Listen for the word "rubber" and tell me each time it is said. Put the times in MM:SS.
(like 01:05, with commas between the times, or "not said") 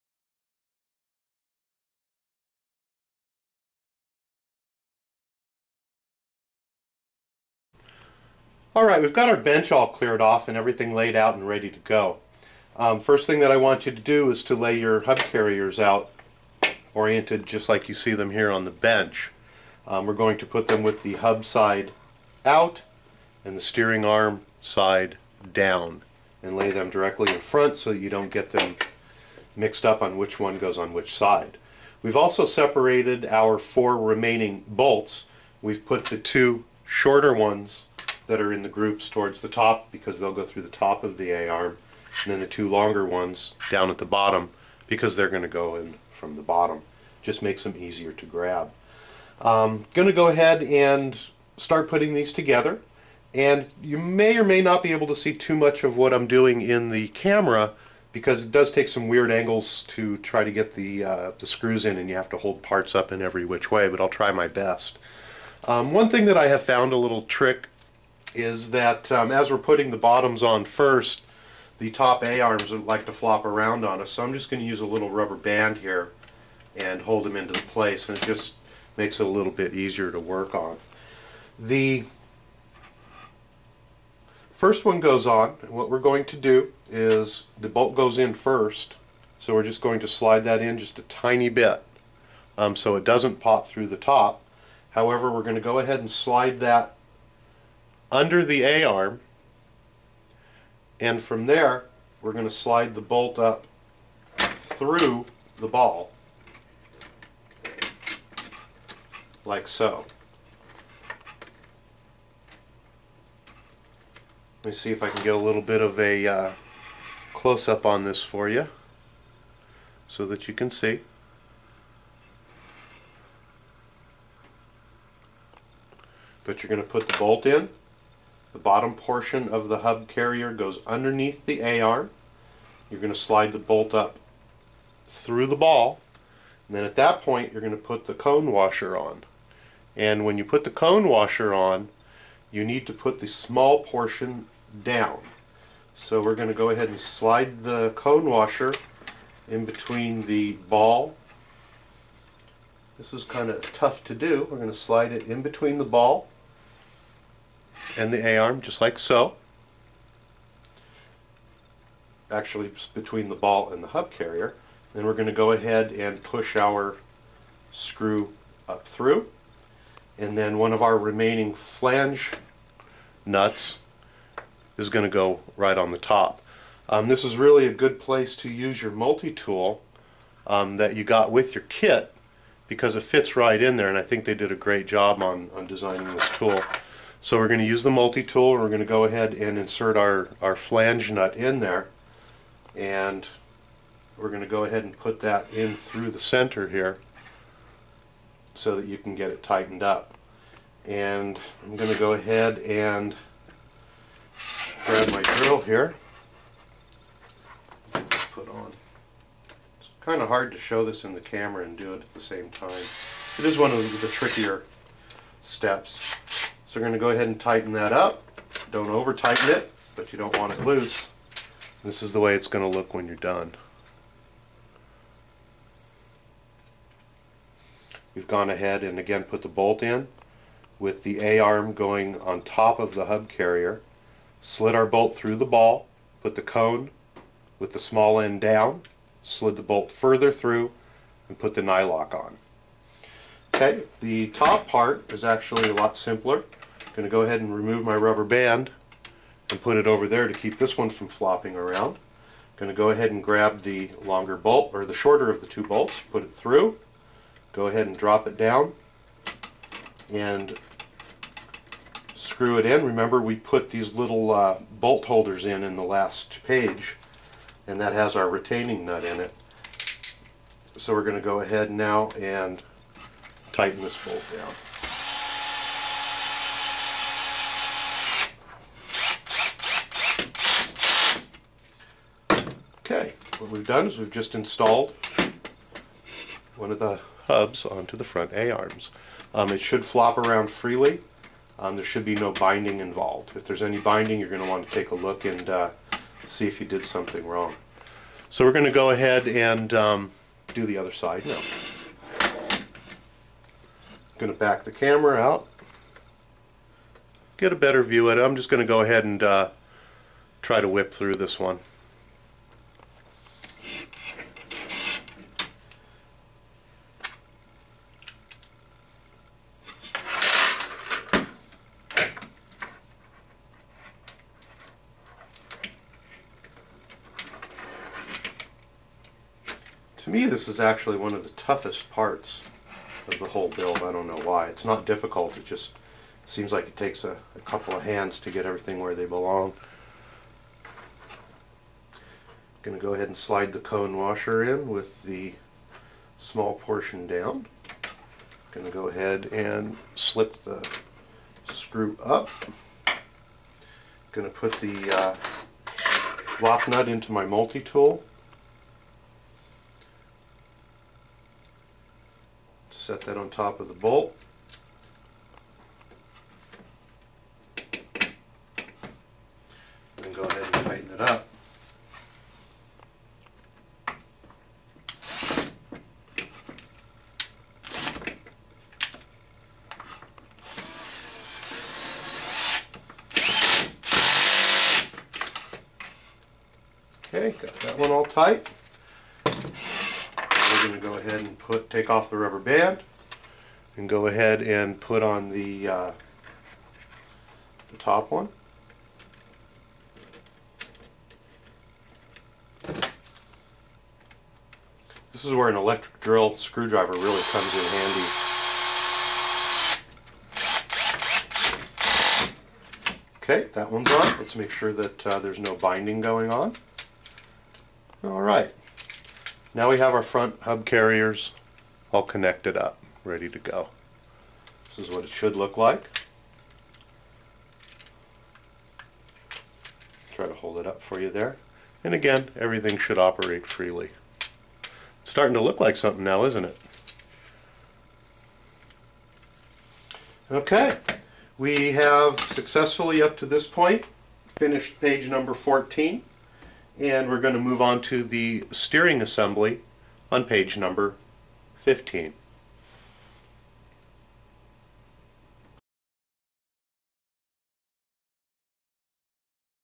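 01:15, 04:07, 06:32.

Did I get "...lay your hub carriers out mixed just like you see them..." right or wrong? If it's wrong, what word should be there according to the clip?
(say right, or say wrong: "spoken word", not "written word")
wrong: "oriented", not "mixed".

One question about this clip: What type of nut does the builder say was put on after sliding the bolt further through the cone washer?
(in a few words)
nylock.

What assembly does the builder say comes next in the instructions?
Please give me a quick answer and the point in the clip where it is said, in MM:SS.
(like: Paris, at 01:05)
steering assembly, at 07:28.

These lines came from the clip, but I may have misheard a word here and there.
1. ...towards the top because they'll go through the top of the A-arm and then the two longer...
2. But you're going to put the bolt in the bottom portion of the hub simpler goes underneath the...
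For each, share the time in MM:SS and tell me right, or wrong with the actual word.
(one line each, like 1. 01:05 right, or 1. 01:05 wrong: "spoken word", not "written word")
1. 00:39 right
2. 02:06 wrong: "carrier", not "simpler".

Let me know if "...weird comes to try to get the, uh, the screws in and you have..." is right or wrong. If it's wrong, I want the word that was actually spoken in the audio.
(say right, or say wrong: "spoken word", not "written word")
wrong: "angles", not "comes".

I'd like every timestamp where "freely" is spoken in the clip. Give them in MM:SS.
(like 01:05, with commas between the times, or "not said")
04:50, 07:13.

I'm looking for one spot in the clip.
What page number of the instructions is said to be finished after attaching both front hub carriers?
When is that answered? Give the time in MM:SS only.
07:24.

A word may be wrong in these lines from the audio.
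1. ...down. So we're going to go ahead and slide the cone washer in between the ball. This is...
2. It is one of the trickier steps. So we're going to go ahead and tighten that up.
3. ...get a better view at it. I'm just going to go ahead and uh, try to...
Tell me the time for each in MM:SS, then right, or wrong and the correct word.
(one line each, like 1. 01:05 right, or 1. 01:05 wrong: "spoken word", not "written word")
1. 02:24 right
2. 03:32 right
3. 05:07 right.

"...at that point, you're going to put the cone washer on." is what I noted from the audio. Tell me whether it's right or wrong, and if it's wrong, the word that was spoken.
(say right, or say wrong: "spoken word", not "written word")
right.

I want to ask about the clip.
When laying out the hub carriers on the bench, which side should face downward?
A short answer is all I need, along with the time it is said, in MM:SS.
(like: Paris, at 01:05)
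steering arm side, at 00:23.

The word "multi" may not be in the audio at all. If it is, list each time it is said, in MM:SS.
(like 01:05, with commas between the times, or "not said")
02:58, 03:07, 05:57.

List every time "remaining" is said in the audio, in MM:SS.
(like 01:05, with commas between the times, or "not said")
00:33, 02:50.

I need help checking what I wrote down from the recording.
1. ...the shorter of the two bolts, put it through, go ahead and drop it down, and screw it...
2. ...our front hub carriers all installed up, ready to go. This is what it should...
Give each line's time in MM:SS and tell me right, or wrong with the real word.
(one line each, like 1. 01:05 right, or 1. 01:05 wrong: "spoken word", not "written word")
1. 04:14 right
2. 06:59 wrong: "connected", not "installed".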